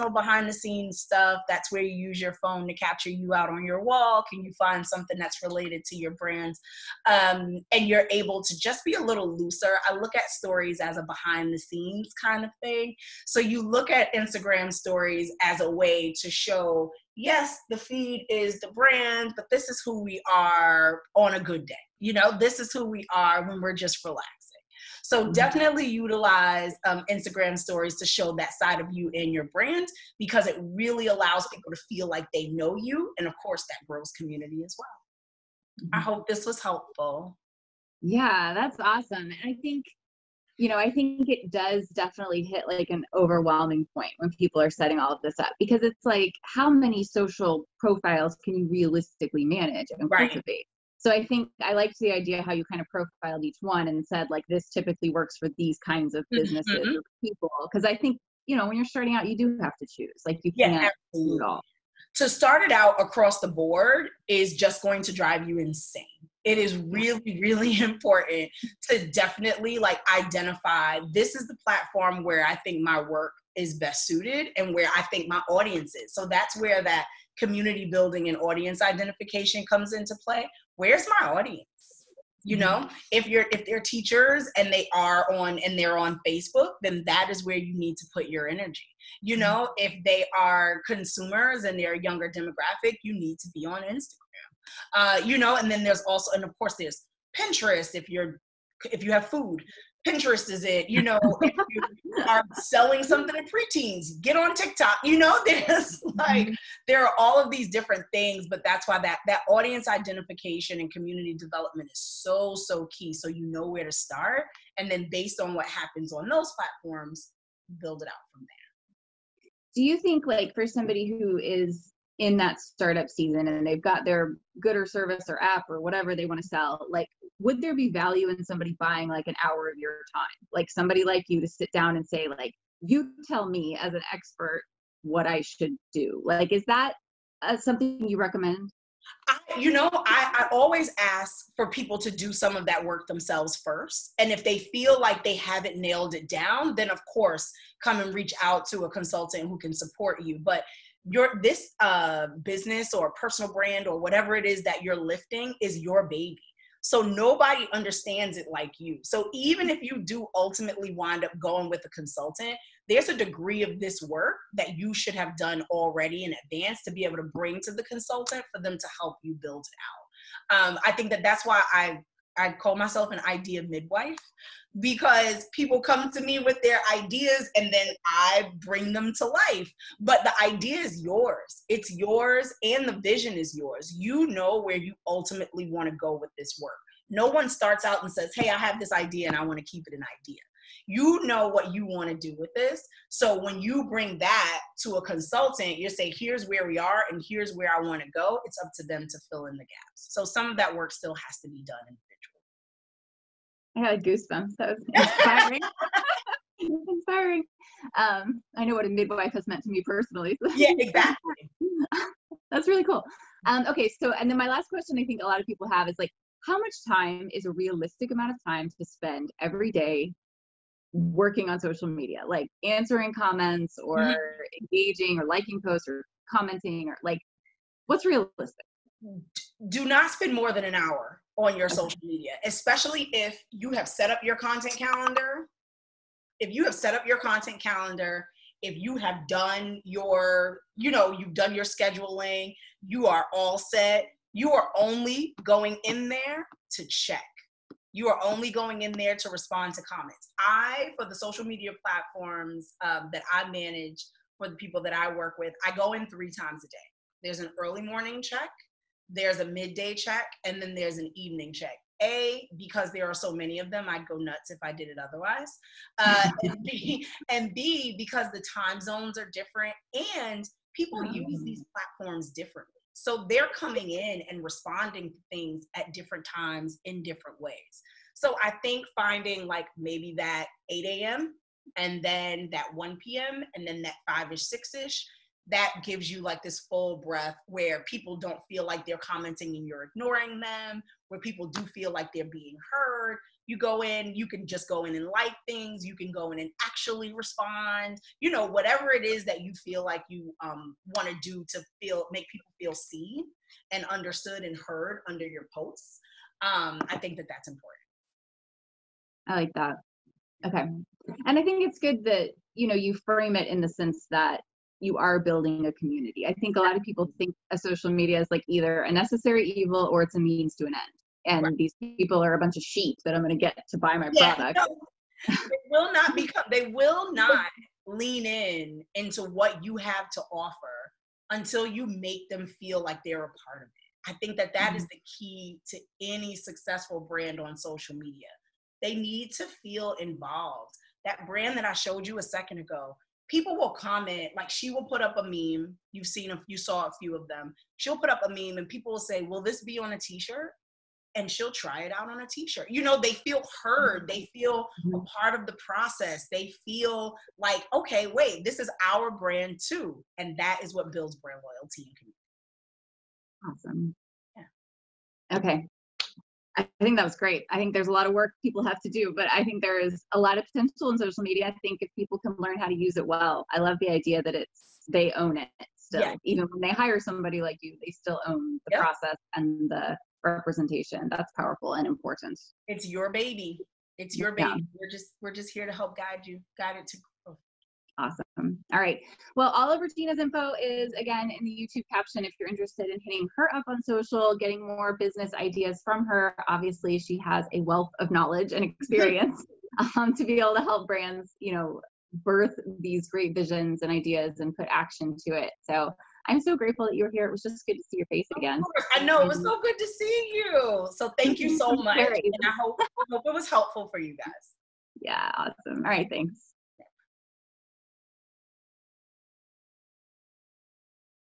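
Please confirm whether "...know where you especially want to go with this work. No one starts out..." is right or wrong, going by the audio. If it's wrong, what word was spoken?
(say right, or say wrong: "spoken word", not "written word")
wrong: "ultimately", not "especially".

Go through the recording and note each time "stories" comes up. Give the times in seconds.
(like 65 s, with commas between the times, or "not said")
10 s, 14 s, 27 s.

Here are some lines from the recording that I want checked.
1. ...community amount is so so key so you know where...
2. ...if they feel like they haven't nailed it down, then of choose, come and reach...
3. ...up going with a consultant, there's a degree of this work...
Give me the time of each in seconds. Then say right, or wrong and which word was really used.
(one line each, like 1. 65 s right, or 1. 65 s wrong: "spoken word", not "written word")
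1. 110 s wrong: "development", not "amount"
2. 144 s wrong: "course", not "choose"
3. 161 s right.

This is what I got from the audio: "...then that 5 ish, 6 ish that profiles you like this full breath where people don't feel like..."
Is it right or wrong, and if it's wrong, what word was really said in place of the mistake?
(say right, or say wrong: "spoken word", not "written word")
wrong: "gives", not "profiles".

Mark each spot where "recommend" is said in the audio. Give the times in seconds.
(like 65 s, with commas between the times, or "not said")
138 s.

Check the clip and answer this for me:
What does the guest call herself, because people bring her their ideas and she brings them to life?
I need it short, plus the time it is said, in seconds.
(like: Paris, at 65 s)
idea midwife, at 173 s.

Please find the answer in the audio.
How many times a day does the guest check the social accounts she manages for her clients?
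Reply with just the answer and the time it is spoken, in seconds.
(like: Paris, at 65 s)
3, at 256 s.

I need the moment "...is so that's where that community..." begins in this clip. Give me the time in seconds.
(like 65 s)
75 s.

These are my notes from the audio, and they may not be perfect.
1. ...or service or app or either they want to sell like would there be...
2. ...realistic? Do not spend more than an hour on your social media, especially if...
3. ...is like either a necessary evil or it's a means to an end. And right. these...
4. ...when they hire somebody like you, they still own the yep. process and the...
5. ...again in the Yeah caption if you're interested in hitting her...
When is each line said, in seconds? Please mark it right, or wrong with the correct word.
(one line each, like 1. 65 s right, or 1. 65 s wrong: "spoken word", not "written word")
1. 124 s wrong: "whatever", not "either"
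2. 228 s right
3. 318 s right
4. 376 s right
5. 390 s wrong: "YouTube", not "Yeah".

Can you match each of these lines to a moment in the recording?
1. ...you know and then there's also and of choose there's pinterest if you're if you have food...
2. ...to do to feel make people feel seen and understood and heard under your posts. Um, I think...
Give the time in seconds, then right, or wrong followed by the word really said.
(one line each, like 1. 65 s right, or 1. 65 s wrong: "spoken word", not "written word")
1. 95 s wrong: "course", not "choose"
2. 301 s right.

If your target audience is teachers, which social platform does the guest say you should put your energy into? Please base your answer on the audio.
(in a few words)
Facebook.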